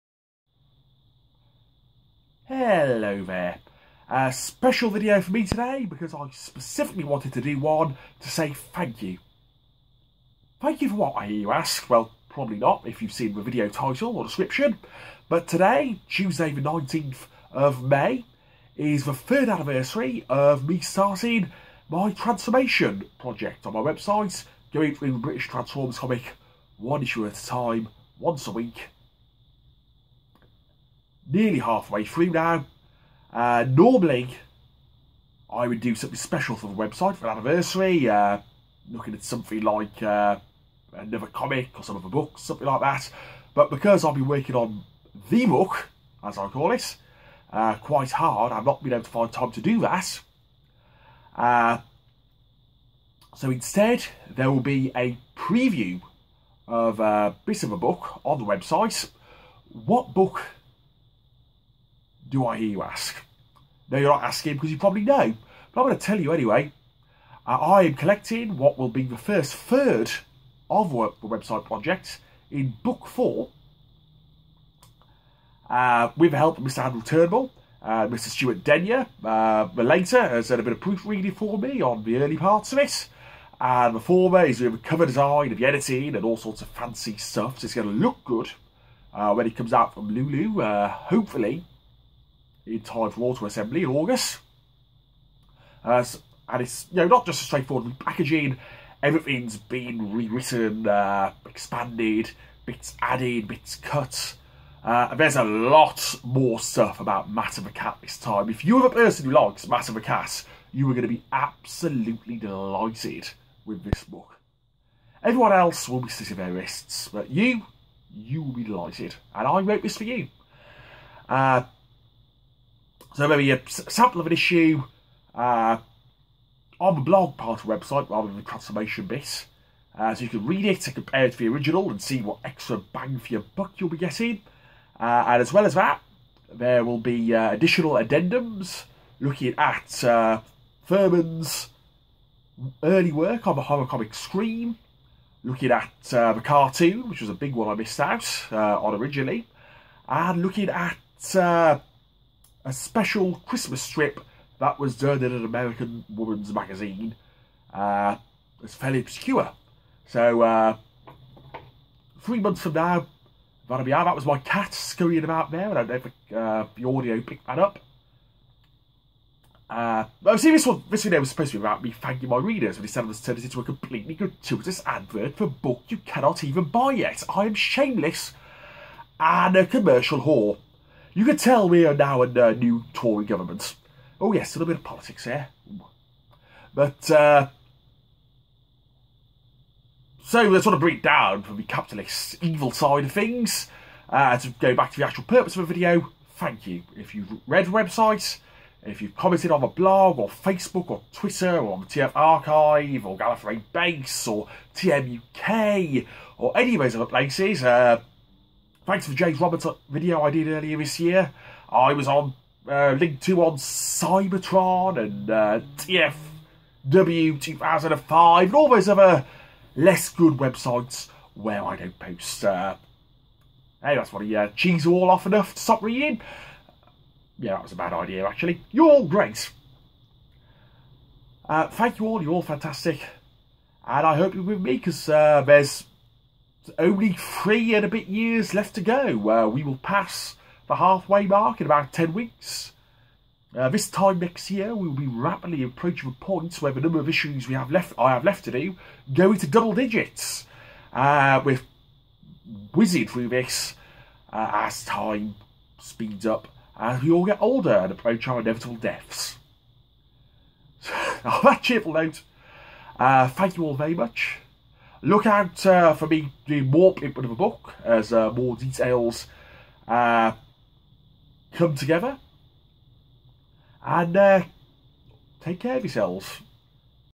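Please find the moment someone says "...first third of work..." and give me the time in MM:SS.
01:09.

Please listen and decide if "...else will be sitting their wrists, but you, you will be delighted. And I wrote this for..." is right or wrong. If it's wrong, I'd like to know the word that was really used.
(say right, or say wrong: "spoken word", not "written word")
right.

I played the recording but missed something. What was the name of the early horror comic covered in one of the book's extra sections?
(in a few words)
Scream.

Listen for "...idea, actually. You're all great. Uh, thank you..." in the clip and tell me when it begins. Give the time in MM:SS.
03:47.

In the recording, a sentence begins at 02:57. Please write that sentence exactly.
I am shameless and a commercial whore.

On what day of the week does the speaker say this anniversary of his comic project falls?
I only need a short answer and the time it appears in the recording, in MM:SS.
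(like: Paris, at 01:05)
Tuesday, at 00:16.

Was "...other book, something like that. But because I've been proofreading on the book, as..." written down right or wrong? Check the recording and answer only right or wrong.
wrong.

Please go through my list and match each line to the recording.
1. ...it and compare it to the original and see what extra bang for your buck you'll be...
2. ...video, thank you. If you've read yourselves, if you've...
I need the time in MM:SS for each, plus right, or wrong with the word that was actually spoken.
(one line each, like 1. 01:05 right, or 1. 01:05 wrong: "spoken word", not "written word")
1. 02:10 right
2. 03:15 wrong: "websites", not "yourselves".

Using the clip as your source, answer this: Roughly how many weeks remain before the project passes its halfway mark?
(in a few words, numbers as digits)
10.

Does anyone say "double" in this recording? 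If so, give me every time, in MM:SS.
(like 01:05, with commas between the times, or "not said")
04:09.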